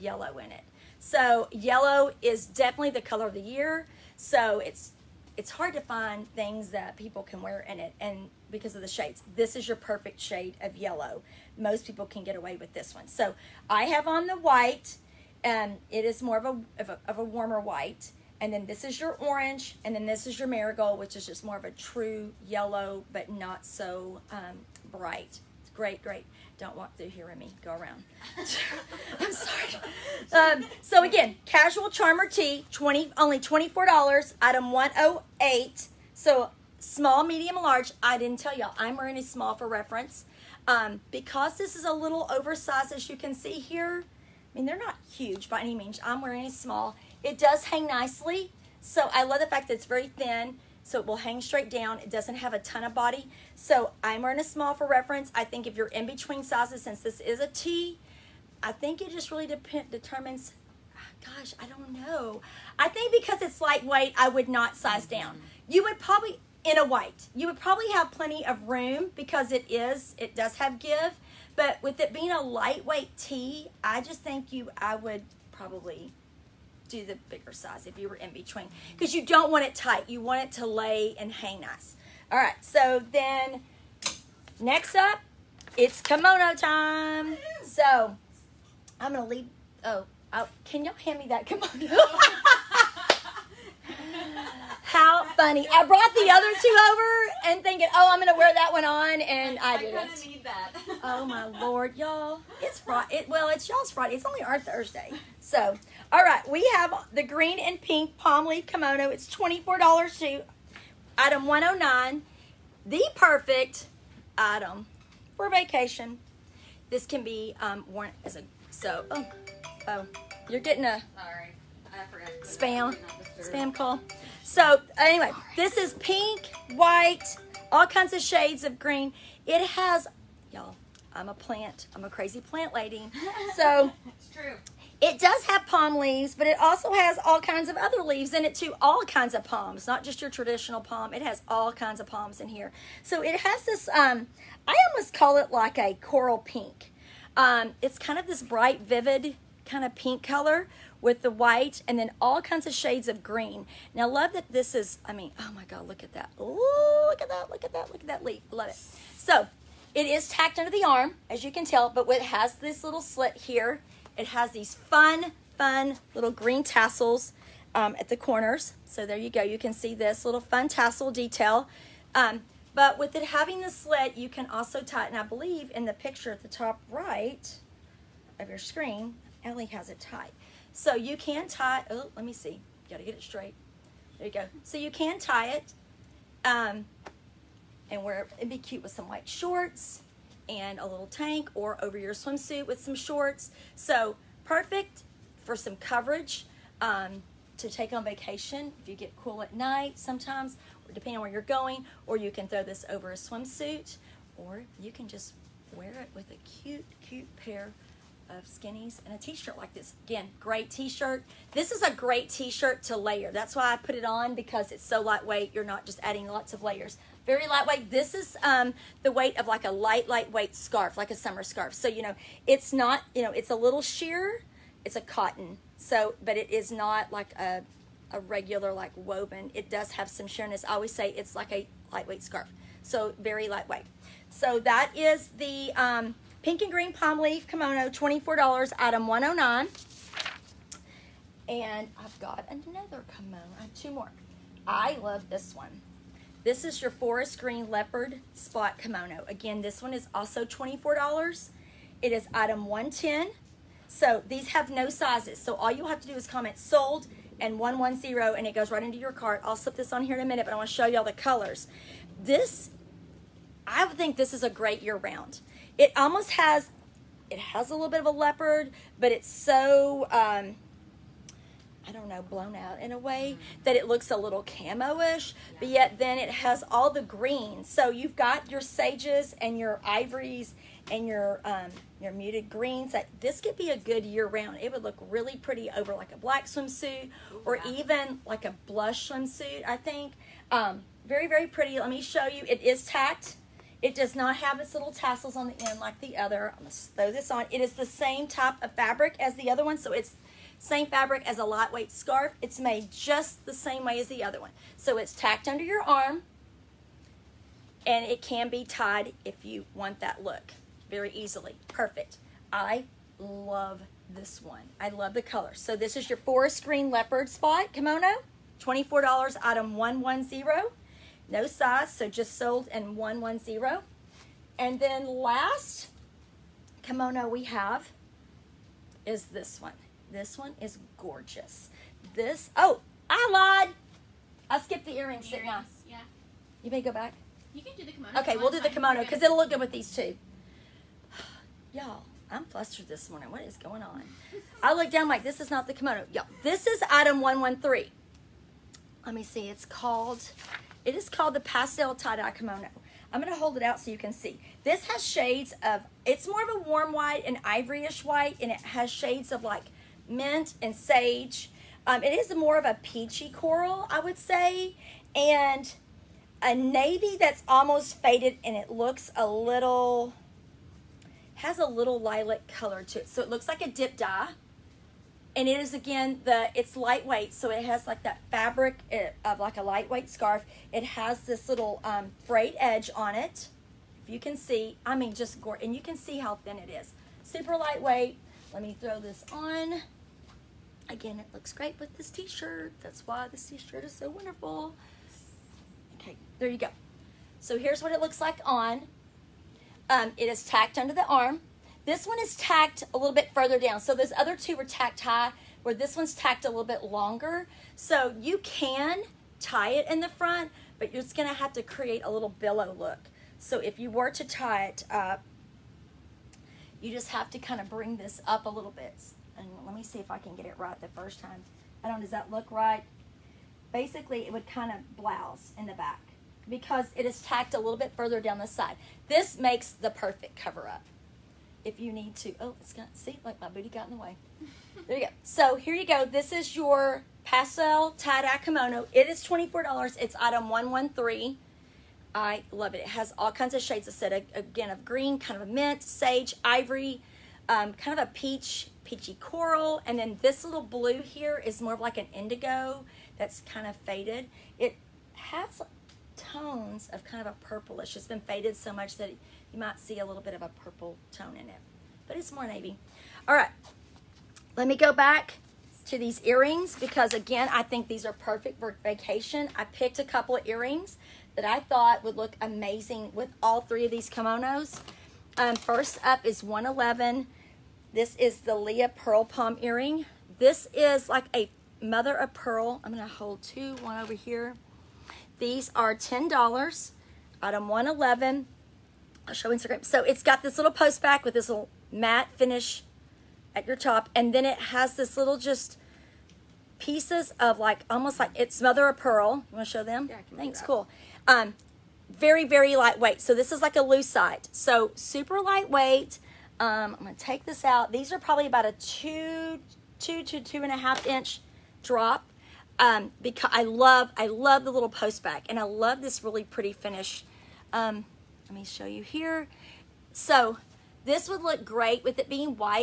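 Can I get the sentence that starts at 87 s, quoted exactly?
So I'm gonna leave, oh, I'll, oh, can y'all hand me that kimono?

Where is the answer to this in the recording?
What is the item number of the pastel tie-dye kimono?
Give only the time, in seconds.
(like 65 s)
346 s.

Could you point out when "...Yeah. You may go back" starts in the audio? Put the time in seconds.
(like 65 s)
335 s.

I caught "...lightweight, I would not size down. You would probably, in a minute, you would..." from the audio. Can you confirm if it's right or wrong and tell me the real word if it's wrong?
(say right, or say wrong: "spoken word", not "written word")
wrong: "white", not "minute".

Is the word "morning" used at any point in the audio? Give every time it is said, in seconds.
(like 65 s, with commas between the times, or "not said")
343 s.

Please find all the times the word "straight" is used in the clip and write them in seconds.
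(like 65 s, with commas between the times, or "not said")
51 s, 183 s.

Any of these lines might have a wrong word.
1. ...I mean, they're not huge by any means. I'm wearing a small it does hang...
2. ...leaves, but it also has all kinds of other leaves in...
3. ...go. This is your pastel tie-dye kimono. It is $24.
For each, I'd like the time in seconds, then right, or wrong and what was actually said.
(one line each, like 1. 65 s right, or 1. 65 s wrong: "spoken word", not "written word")
1. 44 s right
2. 135 s right
3. 435 s right.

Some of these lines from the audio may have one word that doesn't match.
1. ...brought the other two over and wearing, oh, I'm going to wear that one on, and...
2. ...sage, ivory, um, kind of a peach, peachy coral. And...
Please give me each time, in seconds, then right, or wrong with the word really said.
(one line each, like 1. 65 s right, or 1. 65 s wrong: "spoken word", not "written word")
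1. 95 s wrong: "thinking", not "wearing"
2. 445 s right.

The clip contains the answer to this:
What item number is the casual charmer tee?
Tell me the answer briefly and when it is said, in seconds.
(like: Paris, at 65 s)
108, at 34 s.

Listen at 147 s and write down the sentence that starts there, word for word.
Um, it's kind of this bright, vivid kind of pink color with the white and then all kinds of shades of green.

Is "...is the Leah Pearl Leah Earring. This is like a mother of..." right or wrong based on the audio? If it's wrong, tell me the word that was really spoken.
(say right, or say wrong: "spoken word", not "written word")
wrong: "Palm", not "Leah".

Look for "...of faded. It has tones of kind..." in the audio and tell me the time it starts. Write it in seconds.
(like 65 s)
453 s.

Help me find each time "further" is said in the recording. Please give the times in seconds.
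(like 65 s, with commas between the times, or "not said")
403 s, 427 s.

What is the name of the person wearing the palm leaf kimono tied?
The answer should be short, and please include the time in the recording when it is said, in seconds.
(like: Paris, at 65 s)
Ellie, at 179 s.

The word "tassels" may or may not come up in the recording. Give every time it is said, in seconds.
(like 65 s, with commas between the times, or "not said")
166 s, 170 s, 294 s.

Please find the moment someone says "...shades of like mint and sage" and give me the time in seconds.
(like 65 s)
358 s.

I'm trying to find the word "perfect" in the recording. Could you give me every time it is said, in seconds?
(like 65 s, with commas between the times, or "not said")
9 s, 113 s, 194 s, 311 s, 429 s, 468 s.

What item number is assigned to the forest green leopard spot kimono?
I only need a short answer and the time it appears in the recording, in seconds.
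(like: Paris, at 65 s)
110, at 252 s.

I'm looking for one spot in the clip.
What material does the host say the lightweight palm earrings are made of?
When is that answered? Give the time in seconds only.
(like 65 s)
503 s.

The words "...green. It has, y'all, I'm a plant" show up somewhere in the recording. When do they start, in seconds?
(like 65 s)
128 s.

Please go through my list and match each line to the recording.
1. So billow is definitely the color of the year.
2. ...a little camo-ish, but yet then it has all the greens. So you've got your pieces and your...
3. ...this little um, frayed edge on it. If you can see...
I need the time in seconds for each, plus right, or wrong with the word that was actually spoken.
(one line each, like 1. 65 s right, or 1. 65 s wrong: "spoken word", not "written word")
1. 0 s wrong: "yellow", not "billow"
2. 274 s wrong: "sages", not "pieces"
3. 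381 s right.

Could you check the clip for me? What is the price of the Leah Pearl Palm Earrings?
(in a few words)
$10.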